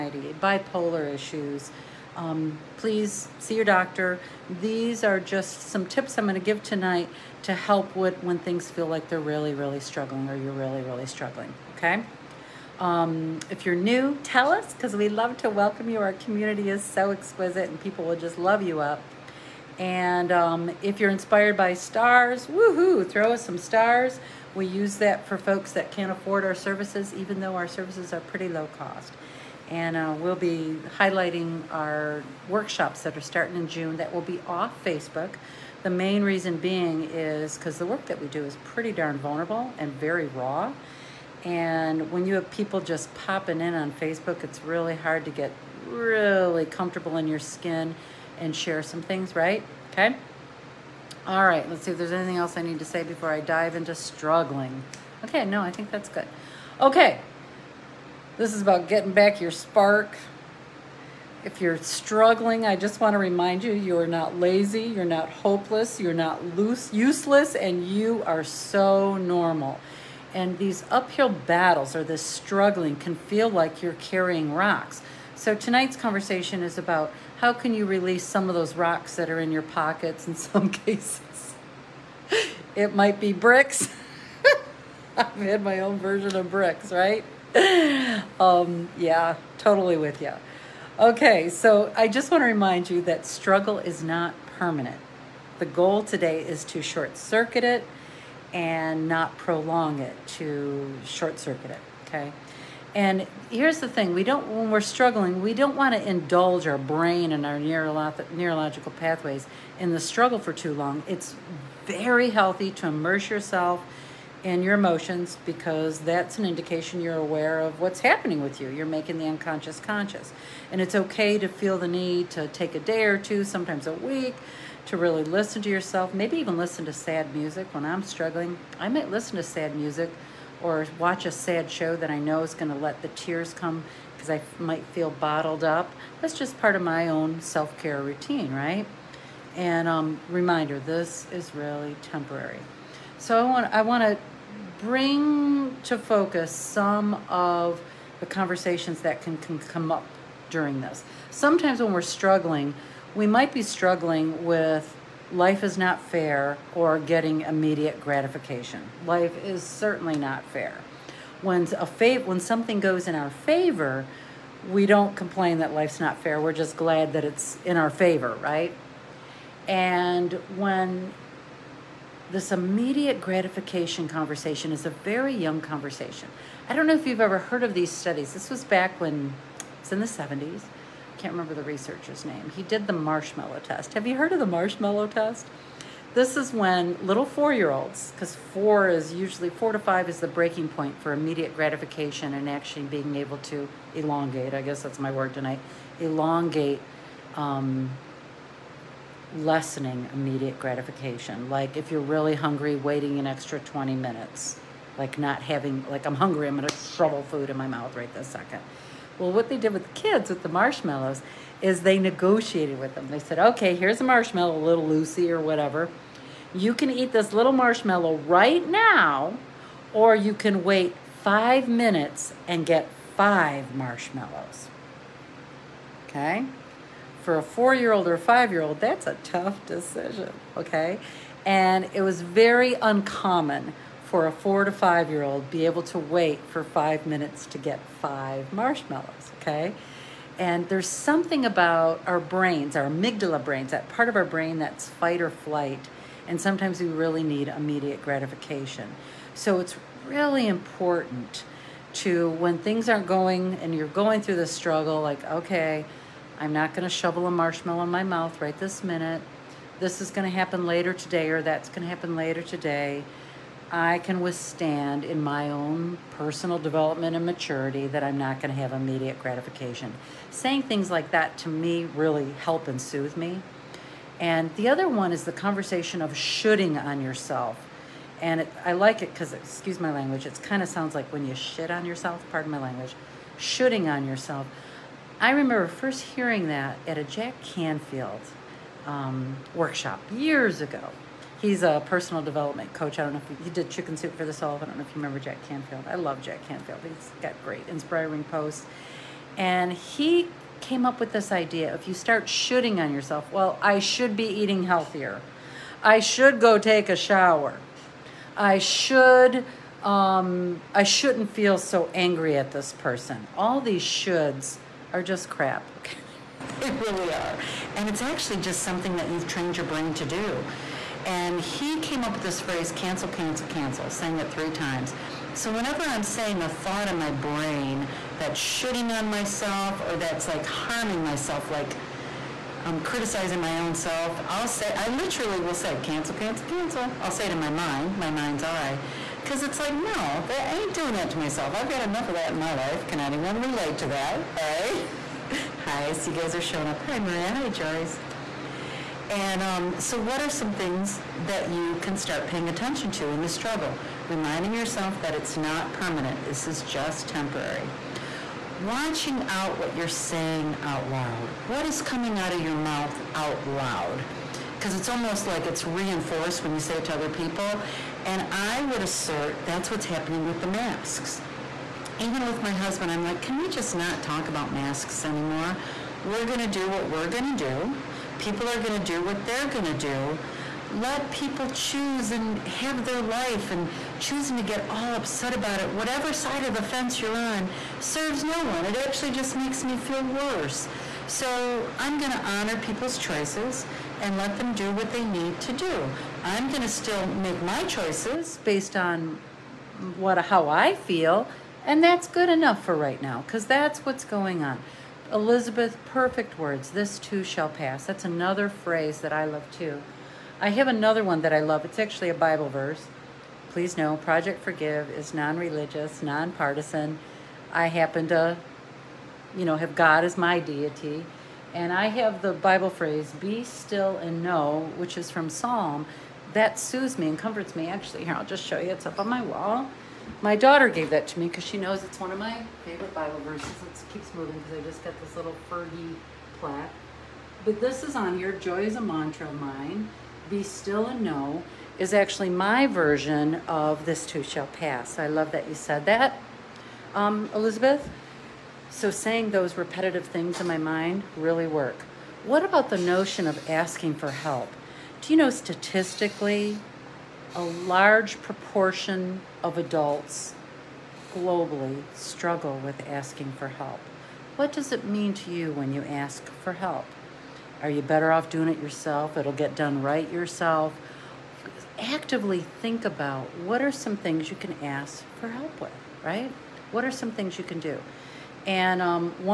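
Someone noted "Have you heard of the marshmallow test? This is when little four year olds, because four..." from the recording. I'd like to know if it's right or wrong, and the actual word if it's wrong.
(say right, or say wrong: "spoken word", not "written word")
right.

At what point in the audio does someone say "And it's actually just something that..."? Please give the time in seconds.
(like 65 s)
317 s.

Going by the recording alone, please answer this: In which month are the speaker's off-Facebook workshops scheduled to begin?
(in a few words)
June.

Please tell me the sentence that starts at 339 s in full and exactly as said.
Because it's like, no, I ain't doing that to myself.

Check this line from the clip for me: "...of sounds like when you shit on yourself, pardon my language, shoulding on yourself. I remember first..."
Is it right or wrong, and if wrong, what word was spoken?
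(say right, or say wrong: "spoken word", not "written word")
right.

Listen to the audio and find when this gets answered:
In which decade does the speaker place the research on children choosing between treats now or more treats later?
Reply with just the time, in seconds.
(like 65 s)
180 s.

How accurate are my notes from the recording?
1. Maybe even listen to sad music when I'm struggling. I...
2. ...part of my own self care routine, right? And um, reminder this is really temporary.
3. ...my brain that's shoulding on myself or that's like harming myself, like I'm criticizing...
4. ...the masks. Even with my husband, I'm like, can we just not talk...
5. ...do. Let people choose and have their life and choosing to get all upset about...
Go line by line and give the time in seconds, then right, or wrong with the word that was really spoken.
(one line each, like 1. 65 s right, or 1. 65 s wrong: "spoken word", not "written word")
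1. 126 s right
2. 136 s right
3. 326 s right
4. 370 s right
5. 379 s right.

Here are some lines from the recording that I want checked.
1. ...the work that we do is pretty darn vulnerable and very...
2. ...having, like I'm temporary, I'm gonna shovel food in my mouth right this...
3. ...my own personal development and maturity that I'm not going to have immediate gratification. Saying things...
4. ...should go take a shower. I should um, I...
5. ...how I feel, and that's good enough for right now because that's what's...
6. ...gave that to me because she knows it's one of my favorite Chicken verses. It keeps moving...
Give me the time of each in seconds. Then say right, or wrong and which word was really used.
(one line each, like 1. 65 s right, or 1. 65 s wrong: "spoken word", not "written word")
1. 37 s right
2. 205 s wrong: "hungry", not "temporary"
3. 265 s right
4. 305 s right
5. 400 s right
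6. 430 s wrong: "Bible", not "Chicken".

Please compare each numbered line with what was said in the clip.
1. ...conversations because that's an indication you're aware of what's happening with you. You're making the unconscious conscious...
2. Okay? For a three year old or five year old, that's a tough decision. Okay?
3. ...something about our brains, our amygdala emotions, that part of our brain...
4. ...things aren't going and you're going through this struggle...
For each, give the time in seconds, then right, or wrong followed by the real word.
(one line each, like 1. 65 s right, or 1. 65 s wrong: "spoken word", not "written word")
1. 114 s wrong: "emotions", not "conversations"
2. 226 s wrong: "four", not "three"
3. 240 s wrong: "brains", not "emotions"
4. 252 s right.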